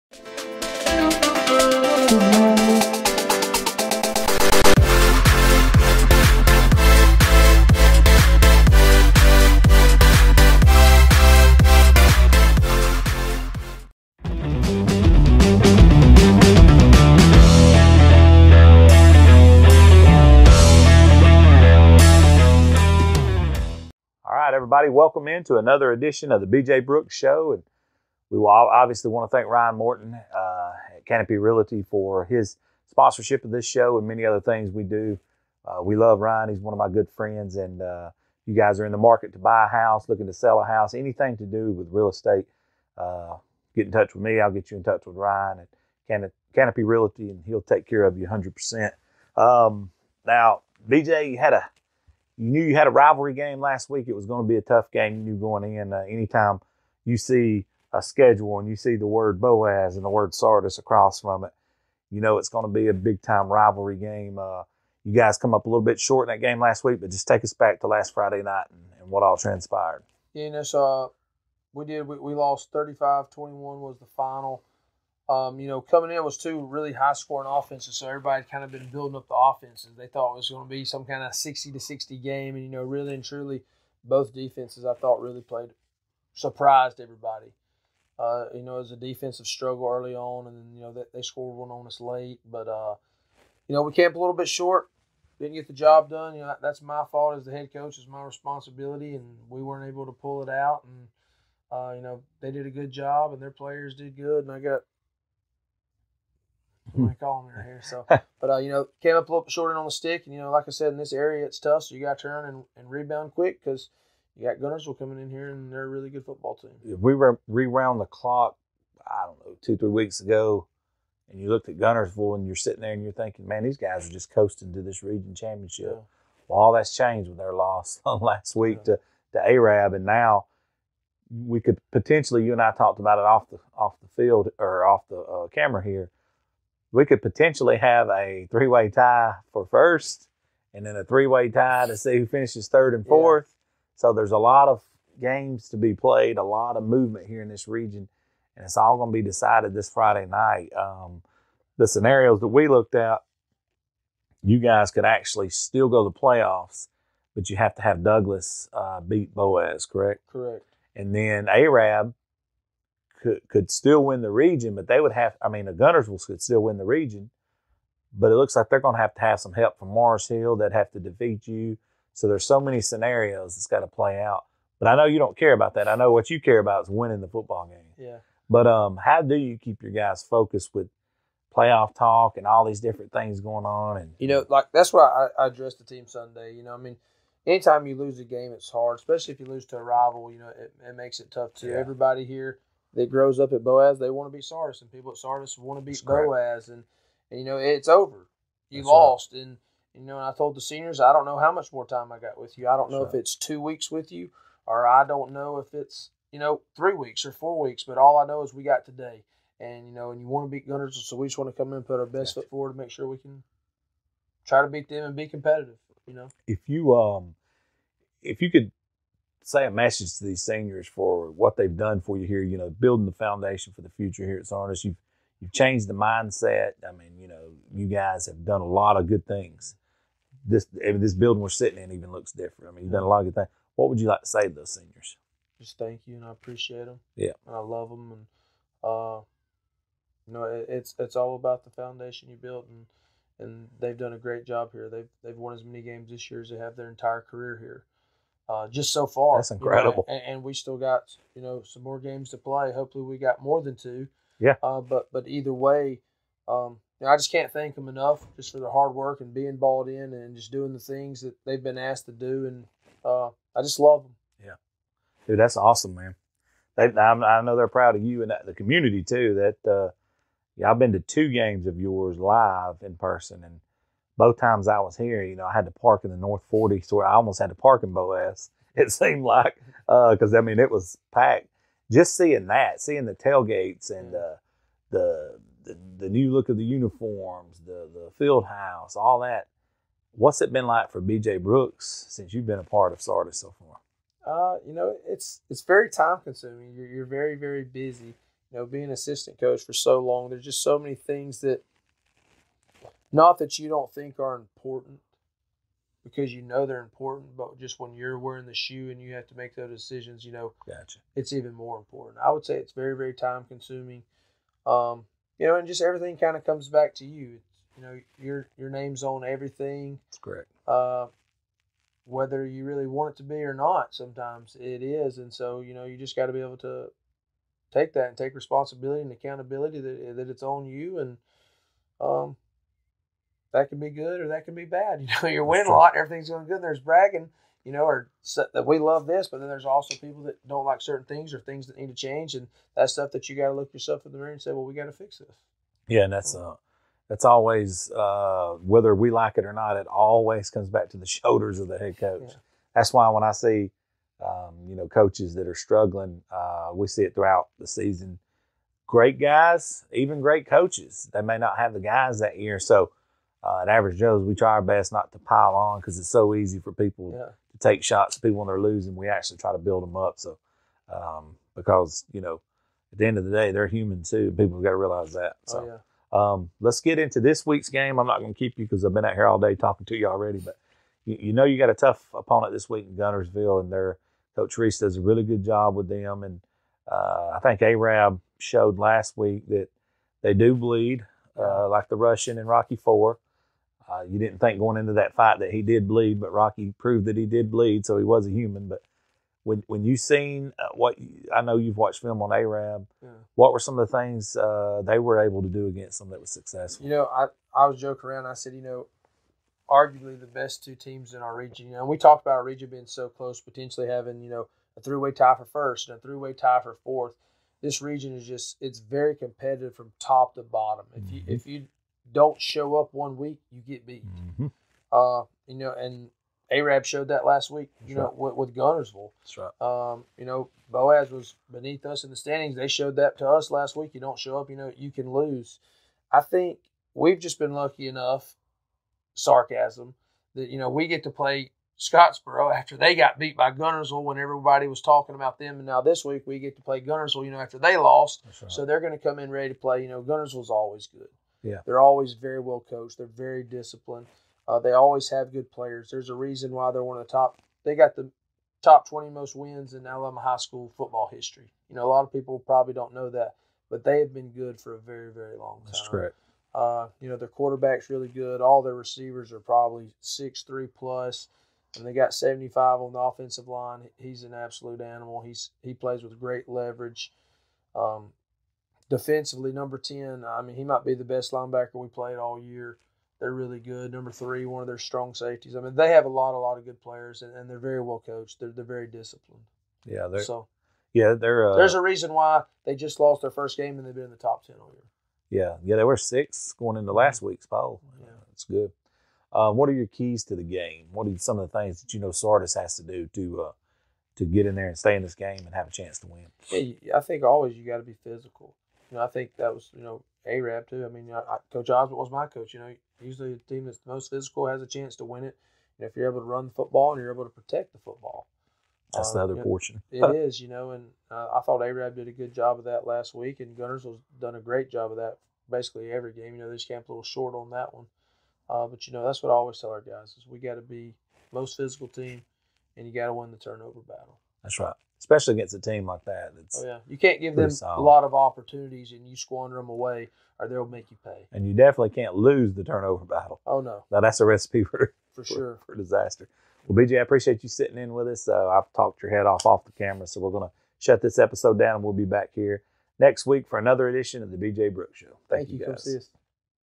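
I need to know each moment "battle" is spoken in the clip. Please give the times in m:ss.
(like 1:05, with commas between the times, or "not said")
8:53, 9:03.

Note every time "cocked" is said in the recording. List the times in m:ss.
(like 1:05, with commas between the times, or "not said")
not said.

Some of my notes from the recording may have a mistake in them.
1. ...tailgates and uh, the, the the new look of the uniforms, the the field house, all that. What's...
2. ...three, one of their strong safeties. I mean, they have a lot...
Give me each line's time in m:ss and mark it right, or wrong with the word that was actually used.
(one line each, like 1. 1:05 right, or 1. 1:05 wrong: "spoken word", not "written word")
1. 4:43 right
2. 8:04 right.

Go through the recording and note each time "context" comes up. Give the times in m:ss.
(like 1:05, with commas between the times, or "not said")
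not said.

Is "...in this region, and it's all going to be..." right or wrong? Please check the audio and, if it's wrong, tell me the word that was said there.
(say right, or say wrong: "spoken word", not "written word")
right.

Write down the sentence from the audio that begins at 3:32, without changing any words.
foot forward to make sure we can try to beat them and be competitive.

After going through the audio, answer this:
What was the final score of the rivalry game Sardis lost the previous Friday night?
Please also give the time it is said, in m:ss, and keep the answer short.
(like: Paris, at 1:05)
35-21, at 1:12.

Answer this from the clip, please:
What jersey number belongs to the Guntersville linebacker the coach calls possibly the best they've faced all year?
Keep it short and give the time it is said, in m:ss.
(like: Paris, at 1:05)
10, at 7:59.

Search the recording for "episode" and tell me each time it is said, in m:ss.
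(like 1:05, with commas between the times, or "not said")
9:11.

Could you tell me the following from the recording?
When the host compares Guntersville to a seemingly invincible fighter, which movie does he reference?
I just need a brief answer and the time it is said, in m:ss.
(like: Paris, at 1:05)
Rocky Four, at 6:32.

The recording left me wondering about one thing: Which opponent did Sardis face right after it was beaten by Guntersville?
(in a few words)
Scottsboro.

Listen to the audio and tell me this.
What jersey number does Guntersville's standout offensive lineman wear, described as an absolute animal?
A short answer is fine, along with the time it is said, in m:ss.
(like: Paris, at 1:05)
75, at 7:52.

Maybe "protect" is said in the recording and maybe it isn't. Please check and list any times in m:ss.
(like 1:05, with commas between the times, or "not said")
8:37.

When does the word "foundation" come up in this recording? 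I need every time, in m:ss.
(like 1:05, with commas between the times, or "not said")
3:43, 4:01.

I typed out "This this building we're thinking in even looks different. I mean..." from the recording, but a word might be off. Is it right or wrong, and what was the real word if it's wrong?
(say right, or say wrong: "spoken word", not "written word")
wrong: "sitting", not "thinking".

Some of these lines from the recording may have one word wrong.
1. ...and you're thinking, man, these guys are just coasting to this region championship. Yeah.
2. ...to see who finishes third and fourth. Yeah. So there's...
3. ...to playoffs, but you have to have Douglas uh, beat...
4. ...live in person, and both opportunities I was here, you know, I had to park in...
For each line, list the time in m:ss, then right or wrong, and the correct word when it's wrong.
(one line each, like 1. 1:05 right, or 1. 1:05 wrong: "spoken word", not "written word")
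1. 2:02 right
2. 2:21 right
3. 2:36 right
4. 4:32 wrong: "times", not "opportunities".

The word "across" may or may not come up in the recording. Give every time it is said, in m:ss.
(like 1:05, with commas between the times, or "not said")
1:00.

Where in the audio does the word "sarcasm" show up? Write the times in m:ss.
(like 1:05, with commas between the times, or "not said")
7:19.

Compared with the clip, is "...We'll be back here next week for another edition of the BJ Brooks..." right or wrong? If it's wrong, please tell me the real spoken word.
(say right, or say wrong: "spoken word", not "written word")
right.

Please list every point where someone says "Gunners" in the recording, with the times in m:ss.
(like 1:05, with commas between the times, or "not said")
3:30, 8:43.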